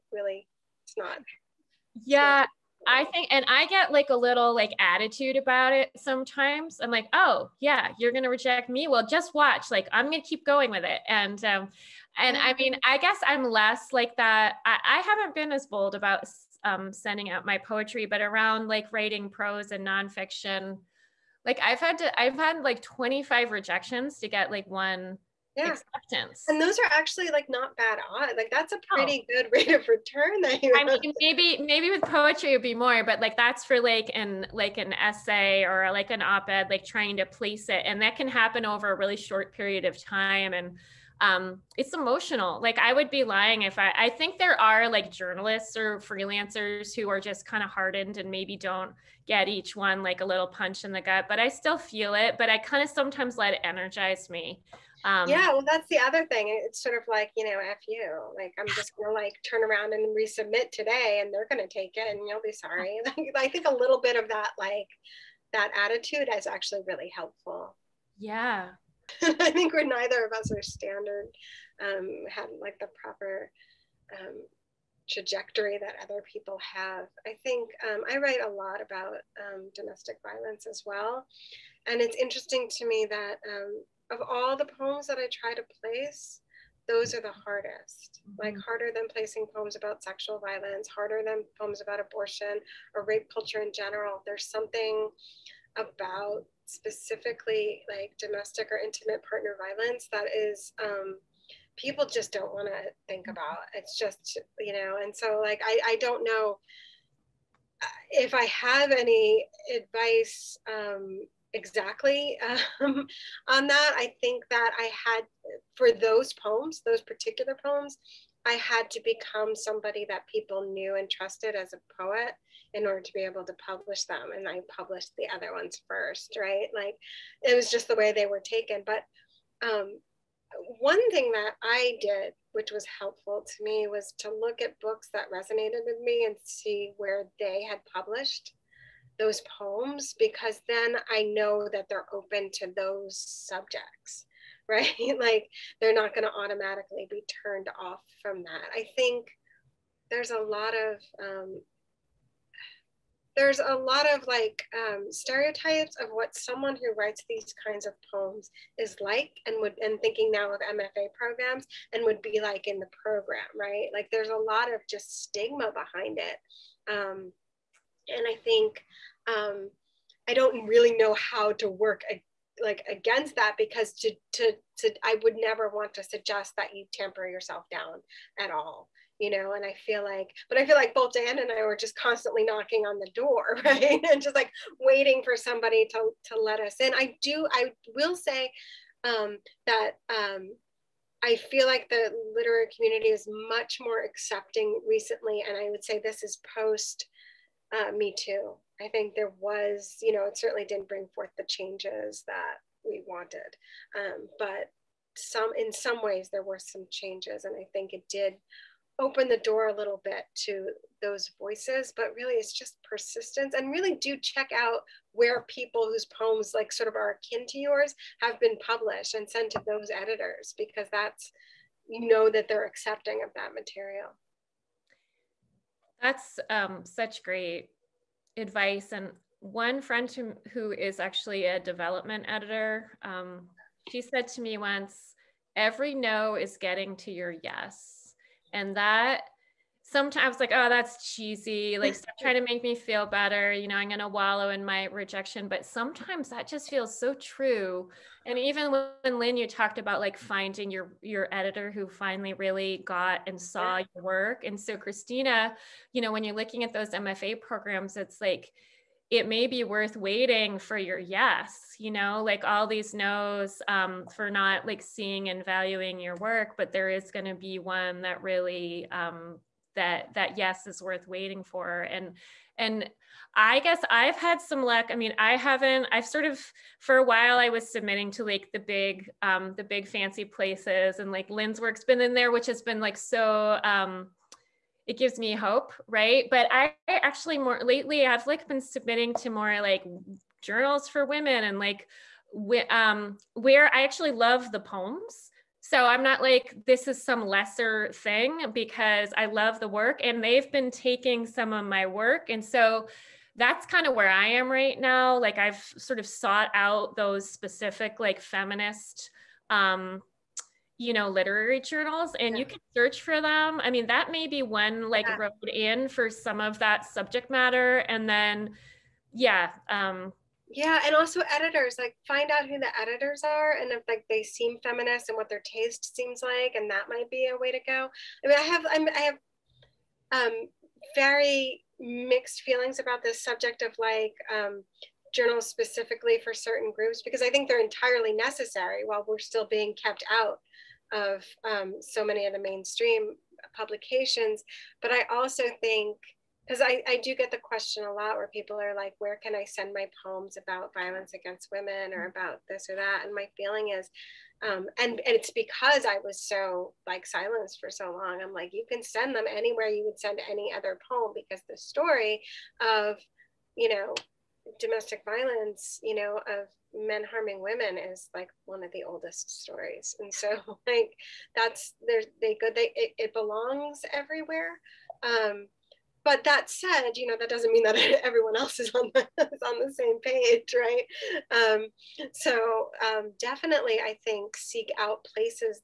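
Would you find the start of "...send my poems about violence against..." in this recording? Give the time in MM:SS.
05:49.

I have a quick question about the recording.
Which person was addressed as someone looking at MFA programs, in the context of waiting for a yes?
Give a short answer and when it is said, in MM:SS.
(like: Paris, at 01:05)
Christina, at 04:14.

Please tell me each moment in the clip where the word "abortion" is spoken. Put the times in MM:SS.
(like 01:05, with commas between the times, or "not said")
01:31.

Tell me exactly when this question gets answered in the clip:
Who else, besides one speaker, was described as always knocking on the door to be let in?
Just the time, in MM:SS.
03:01.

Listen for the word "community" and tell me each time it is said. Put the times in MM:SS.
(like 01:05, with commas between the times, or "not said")
03:12.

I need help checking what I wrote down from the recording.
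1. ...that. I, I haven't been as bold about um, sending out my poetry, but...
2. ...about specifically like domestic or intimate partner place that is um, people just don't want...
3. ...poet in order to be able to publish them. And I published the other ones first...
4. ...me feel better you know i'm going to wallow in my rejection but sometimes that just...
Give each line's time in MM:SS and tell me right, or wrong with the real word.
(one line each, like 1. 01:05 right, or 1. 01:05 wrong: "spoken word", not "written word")
1. 00:14 right
2. 01:35 wrong: "violence", not "place"
3. 02:02 right
4. 04:02 right.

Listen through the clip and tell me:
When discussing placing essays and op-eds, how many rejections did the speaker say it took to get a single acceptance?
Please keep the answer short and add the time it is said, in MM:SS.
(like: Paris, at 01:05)
25, at 00:22.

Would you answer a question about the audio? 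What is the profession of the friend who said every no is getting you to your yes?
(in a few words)
Development editor.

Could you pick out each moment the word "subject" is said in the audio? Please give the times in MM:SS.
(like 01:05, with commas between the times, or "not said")
02:23, 05:16, 05:33.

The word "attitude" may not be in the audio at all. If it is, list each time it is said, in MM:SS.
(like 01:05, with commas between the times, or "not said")
00:04, 01:05.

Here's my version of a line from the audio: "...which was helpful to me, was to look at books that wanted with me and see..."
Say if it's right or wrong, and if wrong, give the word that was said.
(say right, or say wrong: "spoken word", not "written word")
wrong: "resonated", not "wanted".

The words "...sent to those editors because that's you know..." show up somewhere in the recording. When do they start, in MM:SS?
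03:39.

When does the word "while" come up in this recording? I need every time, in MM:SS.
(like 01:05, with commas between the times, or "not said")
04:37, 05:38.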